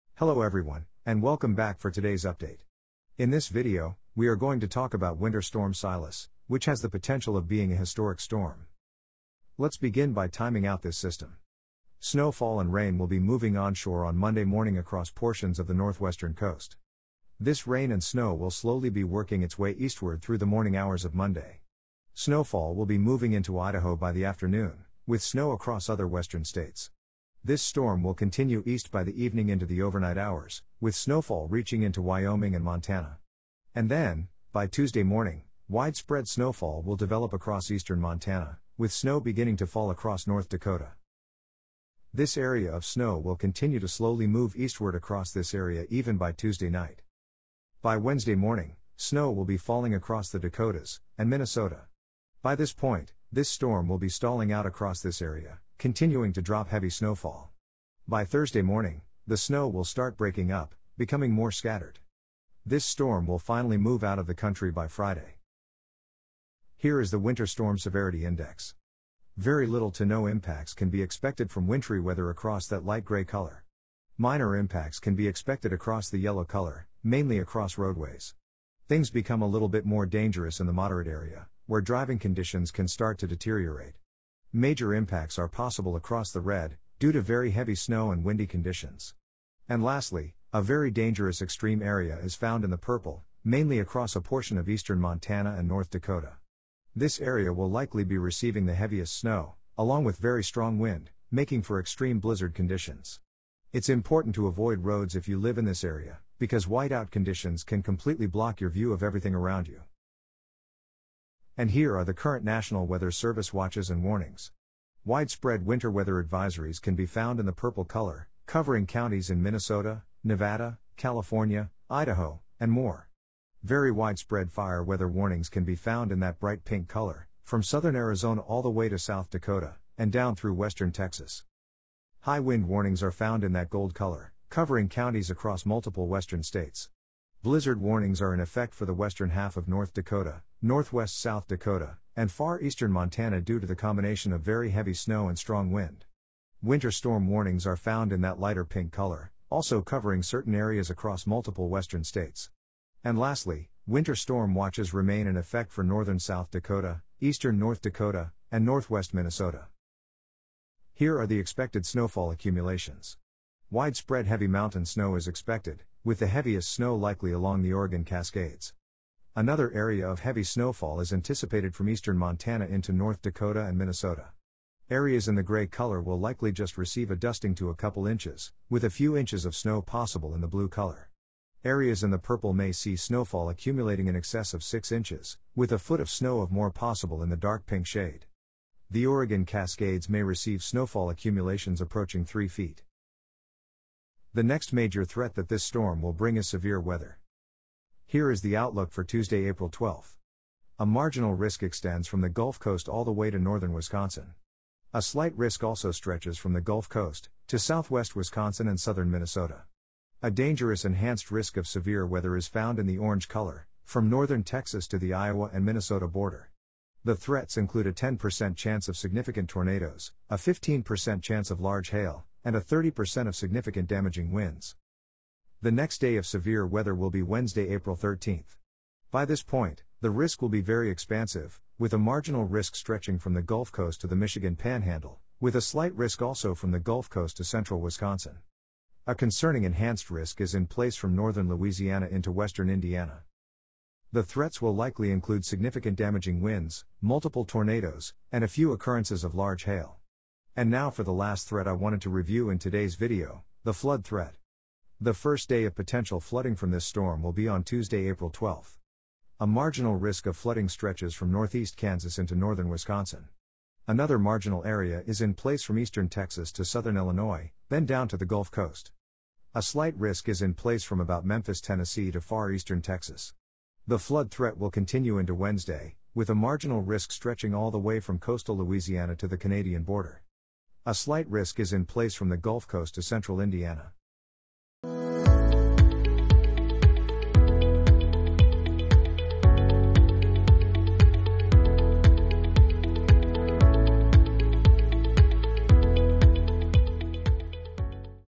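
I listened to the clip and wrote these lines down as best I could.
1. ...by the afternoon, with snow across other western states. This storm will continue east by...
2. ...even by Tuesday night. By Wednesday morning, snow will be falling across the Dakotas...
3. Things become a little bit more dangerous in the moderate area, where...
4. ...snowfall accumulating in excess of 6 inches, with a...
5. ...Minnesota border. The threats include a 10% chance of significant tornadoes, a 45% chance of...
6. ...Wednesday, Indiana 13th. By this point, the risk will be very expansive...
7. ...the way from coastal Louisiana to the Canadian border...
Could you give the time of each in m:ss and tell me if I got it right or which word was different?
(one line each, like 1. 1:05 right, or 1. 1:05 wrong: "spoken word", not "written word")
1. 0:23 right
2. 0:45 right
3. 1:18 right
4. 3:02 right
5. 3:35 wrong: "15", not "45"
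6. 3:47 wrong: "April", not "Indiana"
7. 4:37 right.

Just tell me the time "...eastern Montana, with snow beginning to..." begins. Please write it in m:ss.
0:37.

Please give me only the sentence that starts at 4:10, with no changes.
And now for the last threat I wanted to review in today's video, the flood threat.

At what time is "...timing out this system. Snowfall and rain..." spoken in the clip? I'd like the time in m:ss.
0:10.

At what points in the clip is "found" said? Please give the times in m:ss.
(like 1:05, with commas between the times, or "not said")
1:32, 1:57, 2:05, 2:13, 2:27, 3:32.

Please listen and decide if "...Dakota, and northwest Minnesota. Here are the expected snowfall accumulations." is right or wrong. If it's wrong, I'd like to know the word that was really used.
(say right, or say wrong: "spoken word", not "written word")
right.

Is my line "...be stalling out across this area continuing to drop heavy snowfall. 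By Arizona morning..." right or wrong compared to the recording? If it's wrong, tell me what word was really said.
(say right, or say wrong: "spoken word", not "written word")
wrong: "Thursday", not "Arizona".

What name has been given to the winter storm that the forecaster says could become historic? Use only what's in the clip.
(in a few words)
Winter Storm Silas.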